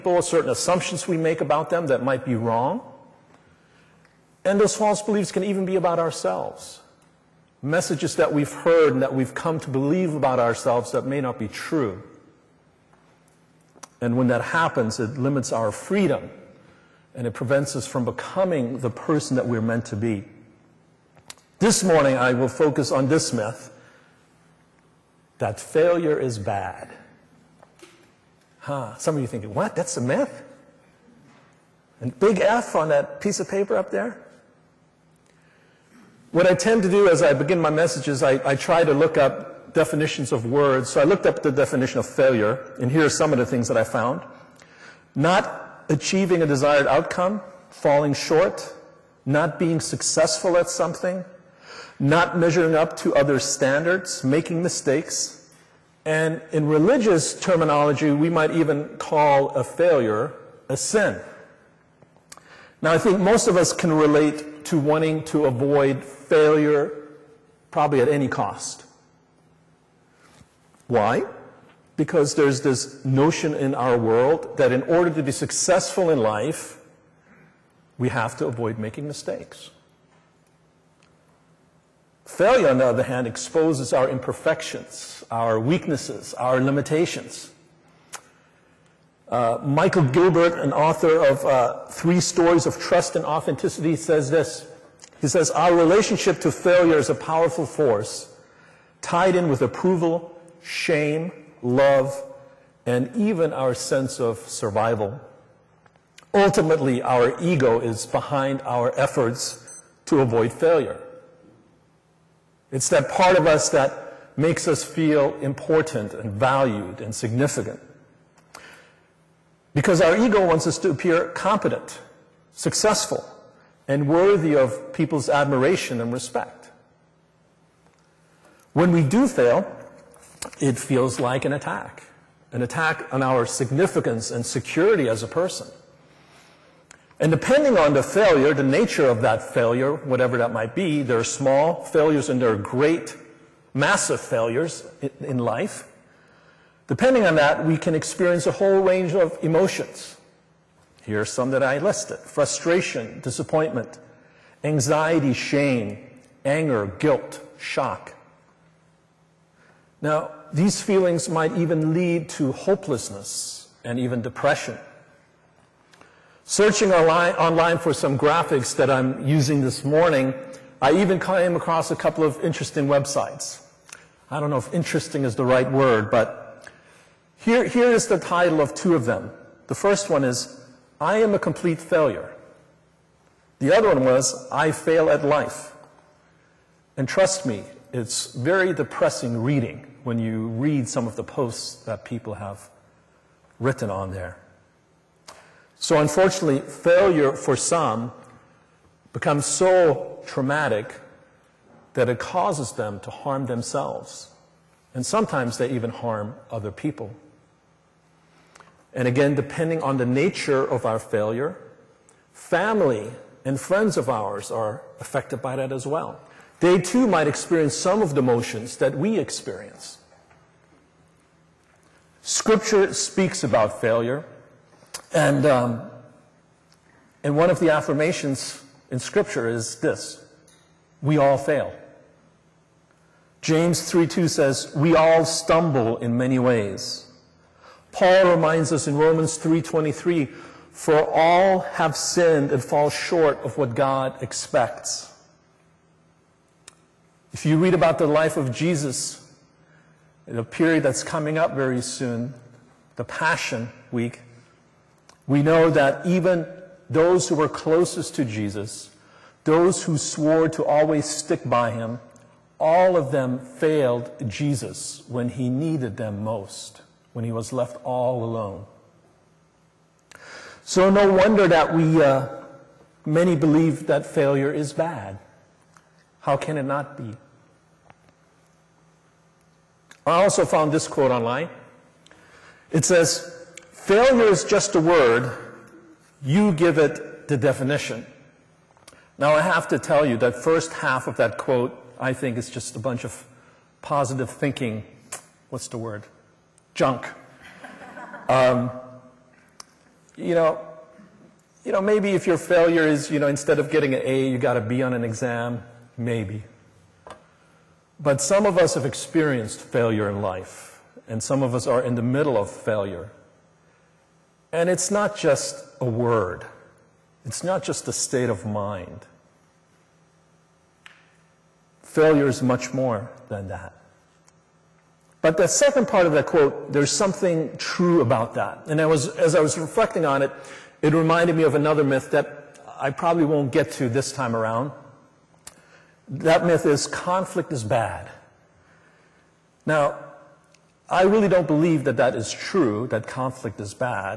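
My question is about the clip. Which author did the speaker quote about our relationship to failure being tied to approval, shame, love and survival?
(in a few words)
Michael Gilbert.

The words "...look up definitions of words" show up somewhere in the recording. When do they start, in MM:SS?
00:38.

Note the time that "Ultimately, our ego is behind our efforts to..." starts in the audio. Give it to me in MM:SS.
01:46.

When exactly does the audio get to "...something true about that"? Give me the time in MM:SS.
05:26.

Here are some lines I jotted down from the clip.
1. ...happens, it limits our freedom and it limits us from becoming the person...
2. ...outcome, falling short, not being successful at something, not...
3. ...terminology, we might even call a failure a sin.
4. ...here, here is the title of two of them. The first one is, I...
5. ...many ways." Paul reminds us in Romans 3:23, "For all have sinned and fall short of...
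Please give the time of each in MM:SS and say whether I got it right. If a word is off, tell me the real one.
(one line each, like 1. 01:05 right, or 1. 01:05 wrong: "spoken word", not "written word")
1. 00:14 wrong: "prevents", not "limits"
2. 00:46 right
3. 00:57 right
4. 02:57 right
5. 03:56 right.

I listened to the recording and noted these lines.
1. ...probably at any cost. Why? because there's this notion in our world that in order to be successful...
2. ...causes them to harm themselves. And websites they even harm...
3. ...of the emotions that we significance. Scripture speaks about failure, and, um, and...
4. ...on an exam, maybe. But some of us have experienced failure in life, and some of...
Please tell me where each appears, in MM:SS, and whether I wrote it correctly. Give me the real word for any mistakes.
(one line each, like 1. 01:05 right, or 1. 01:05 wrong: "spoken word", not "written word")
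1. 01:07 right
2. 03:22 wrong: "sometimes", not "websites"
3. 03:38 wrong: "experience", not "significance"
4. 05:04 right.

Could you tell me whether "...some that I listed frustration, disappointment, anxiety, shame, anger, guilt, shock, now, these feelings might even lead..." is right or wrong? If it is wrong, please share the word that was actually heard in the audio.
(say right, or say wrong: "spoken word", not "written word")
right.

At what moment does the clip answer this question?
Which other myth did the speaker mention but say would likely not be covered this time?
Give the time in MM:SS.
05:36.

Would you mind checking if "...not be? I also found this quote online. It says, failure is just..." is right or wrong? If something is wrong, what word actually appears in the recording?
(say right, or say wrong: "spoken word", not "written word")
right.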